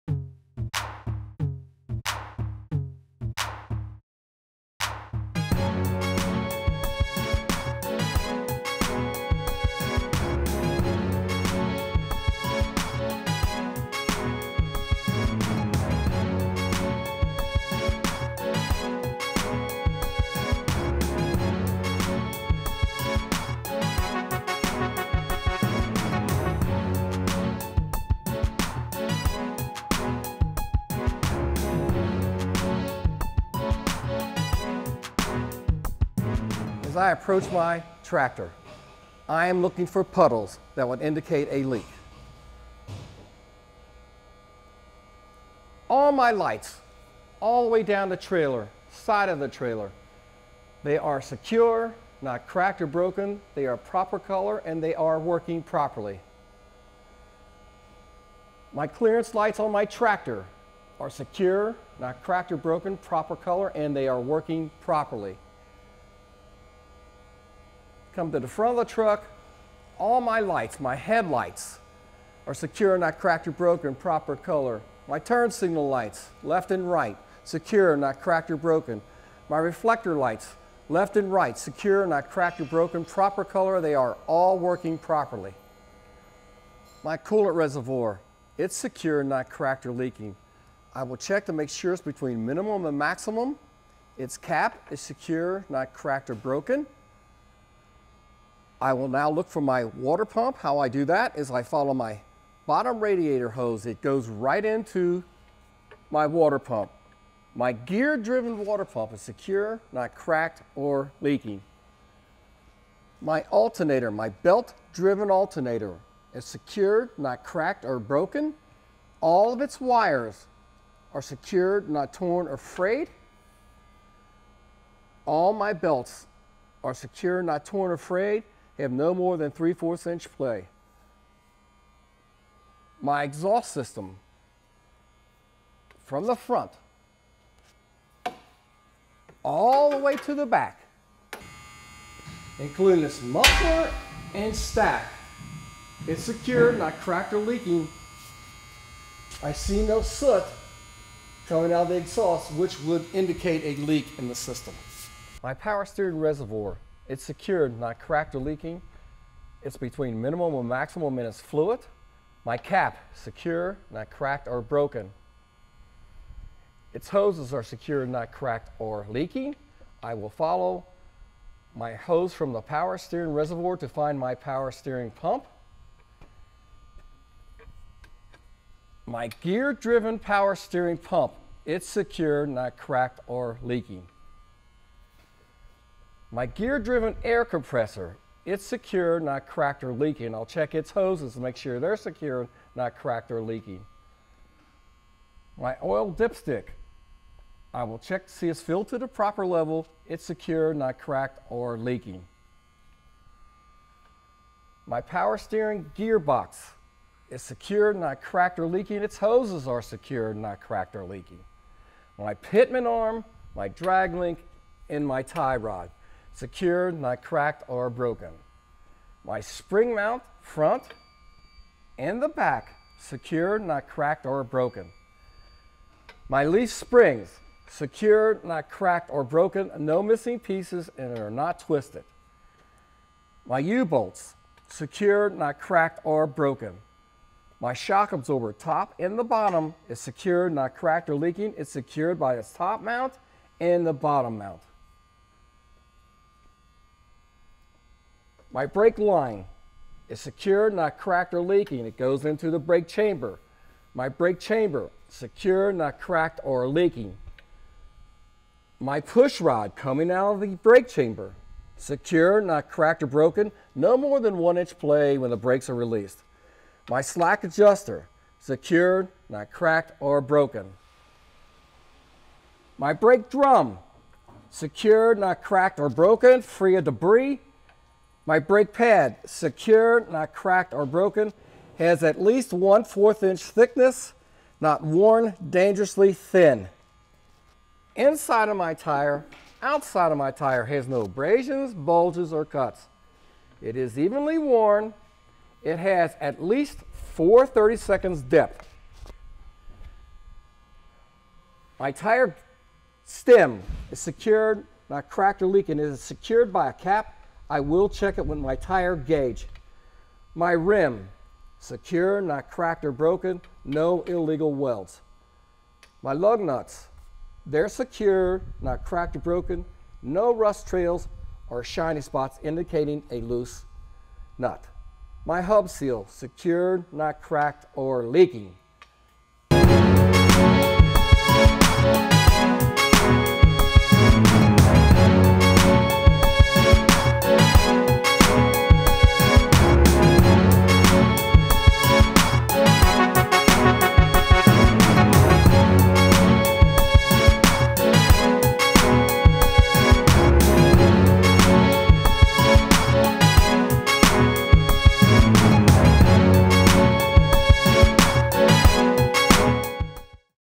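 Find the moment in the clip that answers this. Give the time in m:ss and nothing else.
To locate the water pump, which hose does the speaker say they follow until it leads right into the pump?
1:42.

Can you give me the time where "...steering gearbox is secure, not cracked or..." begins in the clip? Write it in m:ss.
3:25.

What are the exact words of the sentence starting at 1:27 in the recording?
My coolant reservoir, it's secure, not cracked or leaking.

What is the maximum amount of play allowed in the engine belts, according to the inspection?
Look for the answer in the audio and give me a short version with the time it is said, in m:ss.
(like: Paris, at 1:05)
3/4 inch, at 2:09.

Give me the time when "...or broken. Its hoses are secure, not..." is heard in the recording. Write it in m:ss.
2:44.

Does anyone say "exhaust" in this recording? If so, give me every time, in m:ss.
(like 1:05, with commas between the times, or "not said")
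2:13, 2:31.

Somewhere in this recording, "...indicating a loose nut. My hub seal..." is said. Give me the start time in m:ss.
5:22.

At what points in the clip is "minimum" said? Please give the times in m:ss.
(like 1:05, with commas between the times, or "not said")
1:32, 2:40.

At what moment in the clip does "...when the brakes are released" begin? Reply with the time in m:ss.
4:25.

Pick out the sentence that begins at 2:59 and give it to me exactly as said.
My gear driven power steering pump, it's secure, not cracked or leaking.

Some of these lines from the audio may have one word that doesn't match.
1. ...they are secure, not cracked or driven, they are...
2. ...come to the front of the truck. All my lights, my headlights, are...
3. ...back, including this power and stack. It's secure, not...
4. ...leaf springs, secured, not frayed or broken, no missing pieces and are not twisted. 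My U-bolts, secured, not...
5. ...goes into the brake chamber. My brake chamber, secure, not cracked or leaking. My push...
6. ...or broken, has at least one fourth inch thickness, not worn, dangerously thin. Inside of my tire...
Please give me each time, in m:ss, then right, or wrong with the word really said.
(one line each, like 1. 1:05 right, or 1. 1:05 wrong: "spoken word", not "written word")
1. 0:50 wrong: "broken", not "driven"
2. 1:08 right
3. 2:20 wrong: "muffler", not "power"
4. 3:46 wrong: "cracked", not "frayed"
5. 4:11 right
6. 4:40 right.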